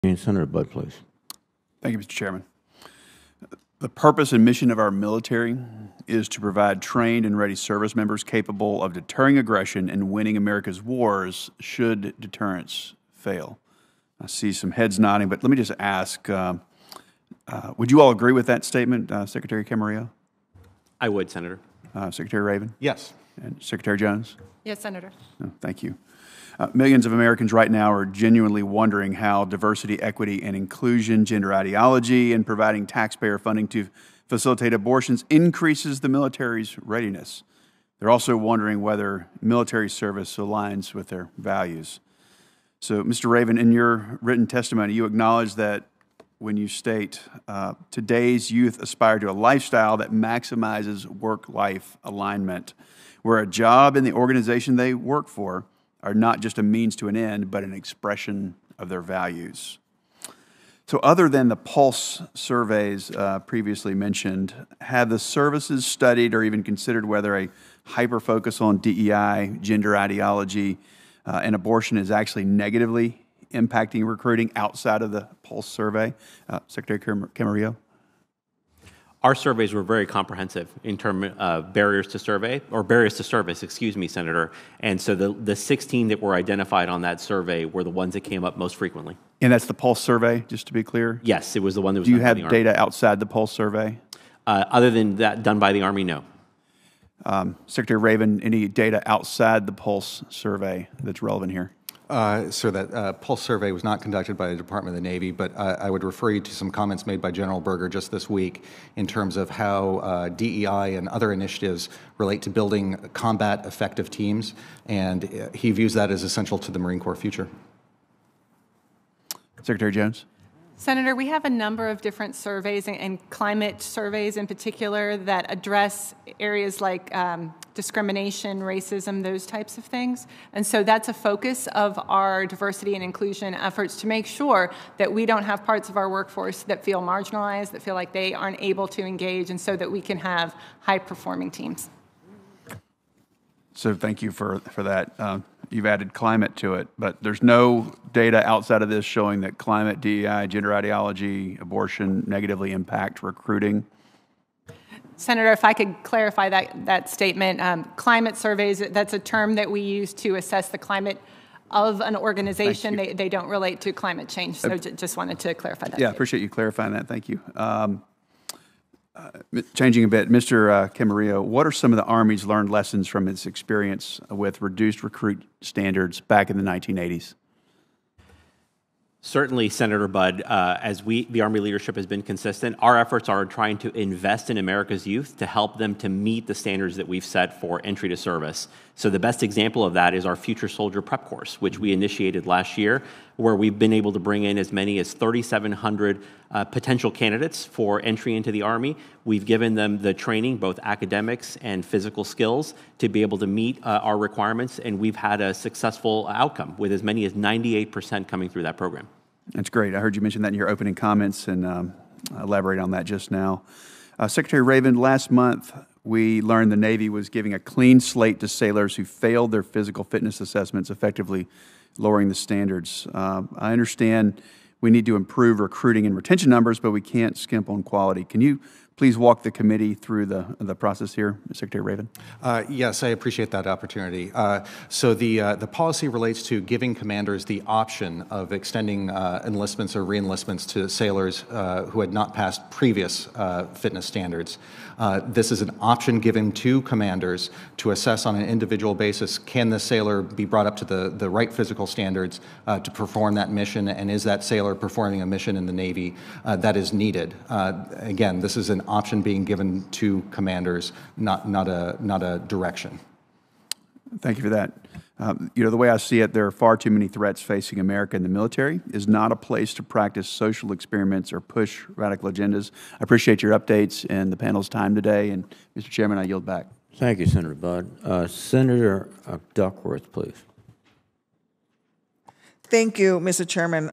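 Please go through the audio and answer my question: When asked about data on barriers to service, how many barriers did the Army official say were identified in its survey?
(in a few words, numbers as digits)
16.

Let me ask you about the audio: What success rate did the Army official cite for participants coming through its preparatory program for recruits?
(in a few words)
98%.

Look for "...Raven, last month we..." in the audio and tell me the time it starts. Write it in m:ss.
3:34.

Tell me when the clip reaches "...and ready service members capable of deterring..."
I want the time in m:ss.
0:07.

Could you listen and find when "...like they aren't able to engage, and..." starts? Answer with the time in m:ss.
2:17.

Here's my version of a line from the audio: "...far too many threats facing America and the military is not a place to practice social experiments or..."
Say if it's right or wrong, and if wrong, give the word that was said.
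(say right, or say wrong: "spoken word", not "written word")
right.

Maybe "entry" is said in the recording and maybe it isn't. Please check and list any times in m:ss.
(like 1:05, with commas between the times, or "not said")
3:07, 3:18.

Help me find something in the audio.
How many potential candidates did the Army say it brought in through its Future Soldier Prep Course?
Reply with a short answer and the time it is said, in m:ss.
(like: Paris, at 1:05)
3,700, at 3:15.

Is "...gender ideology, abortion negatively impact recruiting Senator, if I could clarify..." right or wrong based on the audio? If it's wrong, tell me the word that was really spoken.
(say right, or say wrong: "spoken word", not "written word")
right.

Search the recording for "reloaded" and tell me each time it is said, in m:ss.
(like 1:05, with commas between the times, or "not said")
not said.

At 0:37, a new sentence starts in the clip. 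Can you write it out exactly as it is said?
They're also wondering whether military service aligns with their values.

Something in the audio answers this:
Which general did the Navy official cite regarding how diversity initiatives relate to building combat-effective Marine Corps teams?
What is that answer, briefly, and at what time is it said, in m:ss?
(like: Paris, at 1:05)
General Berger, at 1:47.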